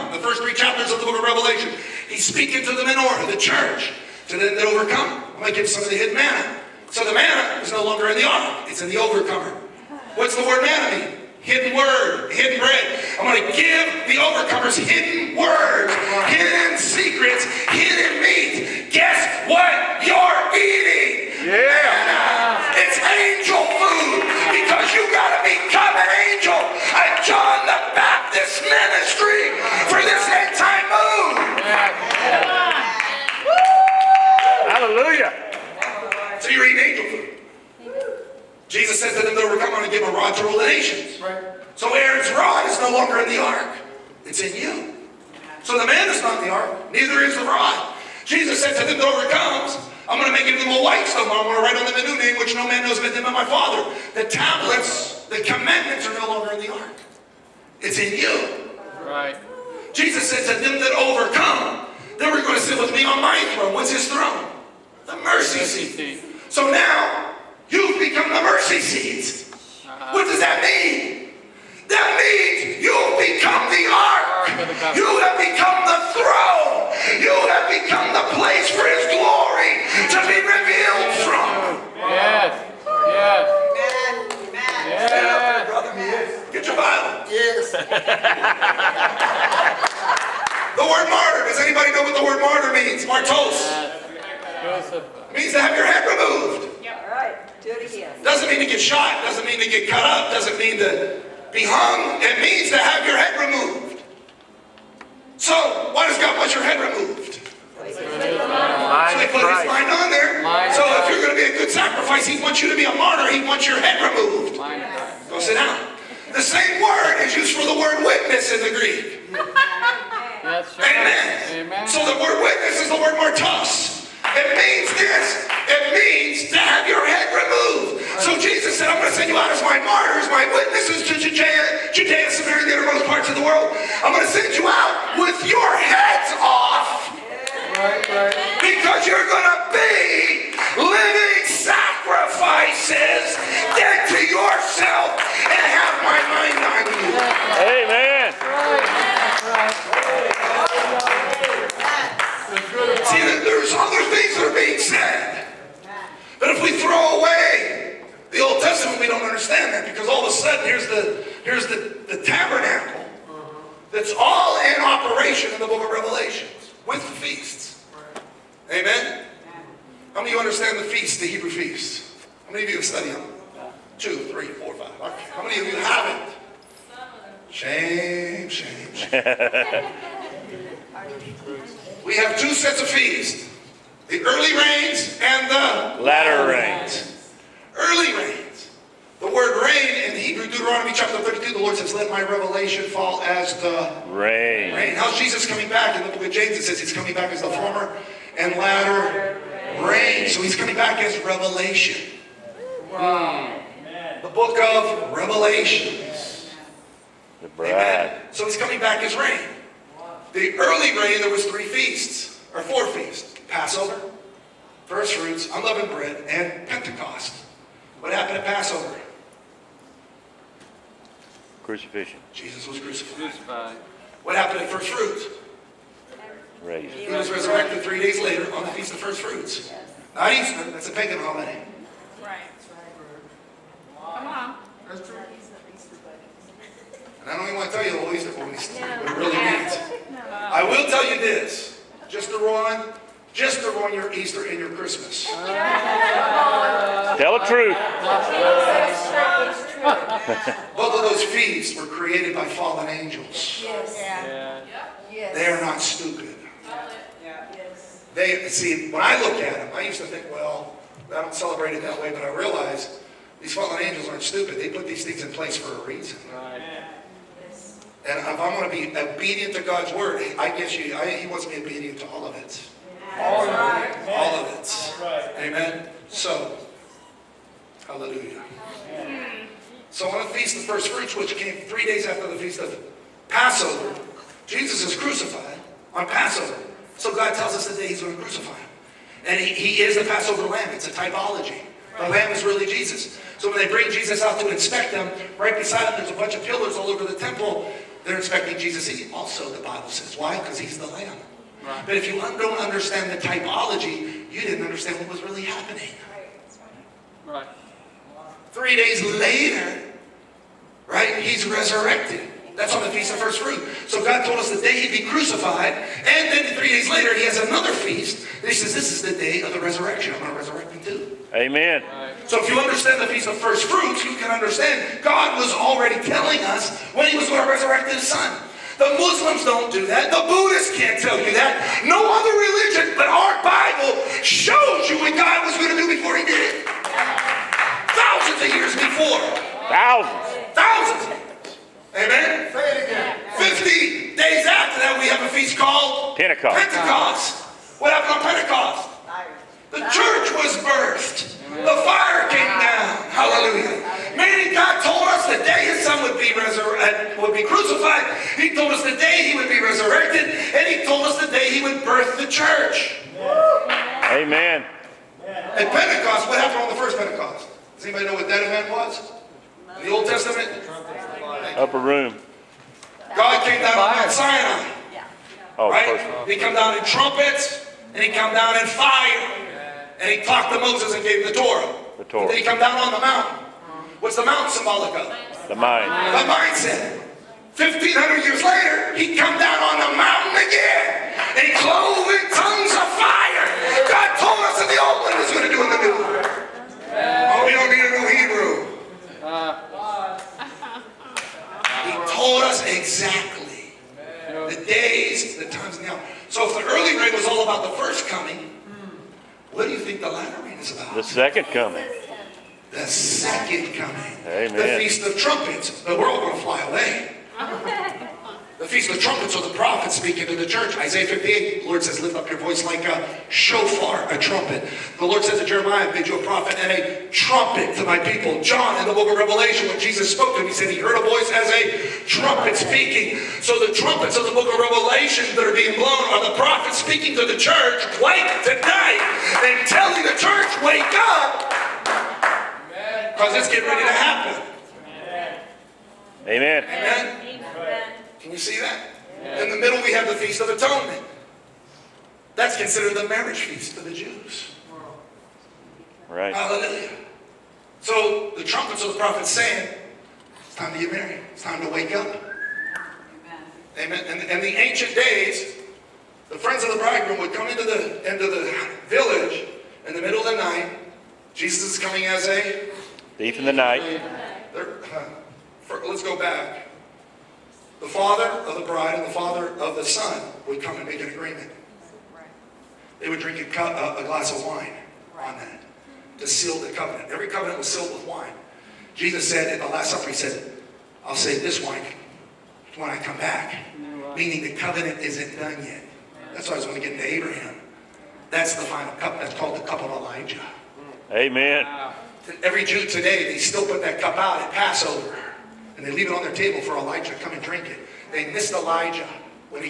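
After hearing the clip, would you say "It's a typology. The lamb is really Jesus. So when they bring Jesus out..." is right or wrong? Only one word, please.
right.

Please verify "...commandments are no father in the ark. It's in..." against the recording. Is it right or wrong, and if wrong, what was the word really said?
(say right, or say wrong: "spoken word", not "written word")
wrong: "longer", not "father".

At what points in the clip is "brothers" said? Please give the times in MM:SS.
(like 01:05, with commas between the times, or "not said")
not said.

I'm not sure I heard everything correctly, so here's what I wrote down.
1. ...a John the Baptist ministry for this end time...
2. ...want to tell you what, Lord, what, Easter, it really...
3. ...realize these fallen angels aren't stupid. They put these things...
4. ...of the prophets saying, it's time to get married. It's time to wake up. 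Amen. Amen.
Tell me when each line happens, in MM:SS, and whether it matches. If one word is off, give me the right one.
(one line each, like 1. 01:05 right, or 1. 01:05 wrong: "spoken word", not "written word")
1. 00:26 right
2. 03:57 wrong: "Easter", not "Lord"
3. 04:22 right
4. 07:38 right.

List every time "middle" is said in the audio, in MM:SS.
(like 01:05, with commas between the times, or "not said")
07:29, 07:50.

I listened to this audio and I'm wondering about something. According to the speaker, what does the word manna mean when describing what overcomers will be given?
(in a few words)
Hidden word, hidden bread.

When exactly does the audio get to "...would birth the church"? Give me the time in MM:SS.
06:01.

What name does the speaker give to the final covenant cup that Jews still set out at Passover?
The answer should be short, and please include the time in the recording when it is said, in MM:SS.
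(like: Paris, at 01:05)
Cup of Elijah, at 08:19.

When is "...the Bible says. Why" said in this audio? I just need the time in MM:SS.
04:59.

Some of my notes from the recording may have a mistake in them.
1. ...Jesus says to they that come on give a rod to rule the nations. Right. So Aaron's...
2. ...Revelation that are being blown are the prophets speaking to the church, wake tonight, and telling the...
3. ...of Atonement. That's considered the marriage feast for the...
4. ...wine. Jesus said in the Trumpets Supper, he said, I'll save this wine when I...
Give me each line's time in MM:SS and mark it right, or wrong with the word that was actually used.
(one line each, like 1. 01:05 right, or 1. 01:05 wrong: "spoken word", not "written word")
1. 00:38 right
2. 07:14 right
3. 07:30 right
4. 08:08 wrong: "Last", not "Trumpets".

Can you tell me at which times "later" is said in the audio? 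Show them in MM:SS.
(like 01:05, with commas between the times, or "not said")
03:48, 05:09, 05:16, 06:28.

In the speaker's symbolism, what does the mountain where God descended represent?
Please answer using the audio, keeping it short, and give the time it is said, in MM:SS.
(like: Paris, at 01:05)
The mind, at 06:25.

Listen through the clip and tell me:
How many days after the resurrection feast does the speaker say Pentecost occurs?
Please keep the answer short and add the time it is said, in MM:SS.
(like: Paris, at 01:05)
50, at 05:43.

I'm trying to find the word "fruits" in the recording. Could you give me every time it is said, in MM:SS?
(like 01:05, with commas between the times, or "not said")
03:35, 03:44, 03:49, 04:40, 05:13, 05:23.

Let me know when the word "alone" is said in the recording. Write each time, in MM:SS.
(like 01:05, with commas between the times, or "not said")
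not said.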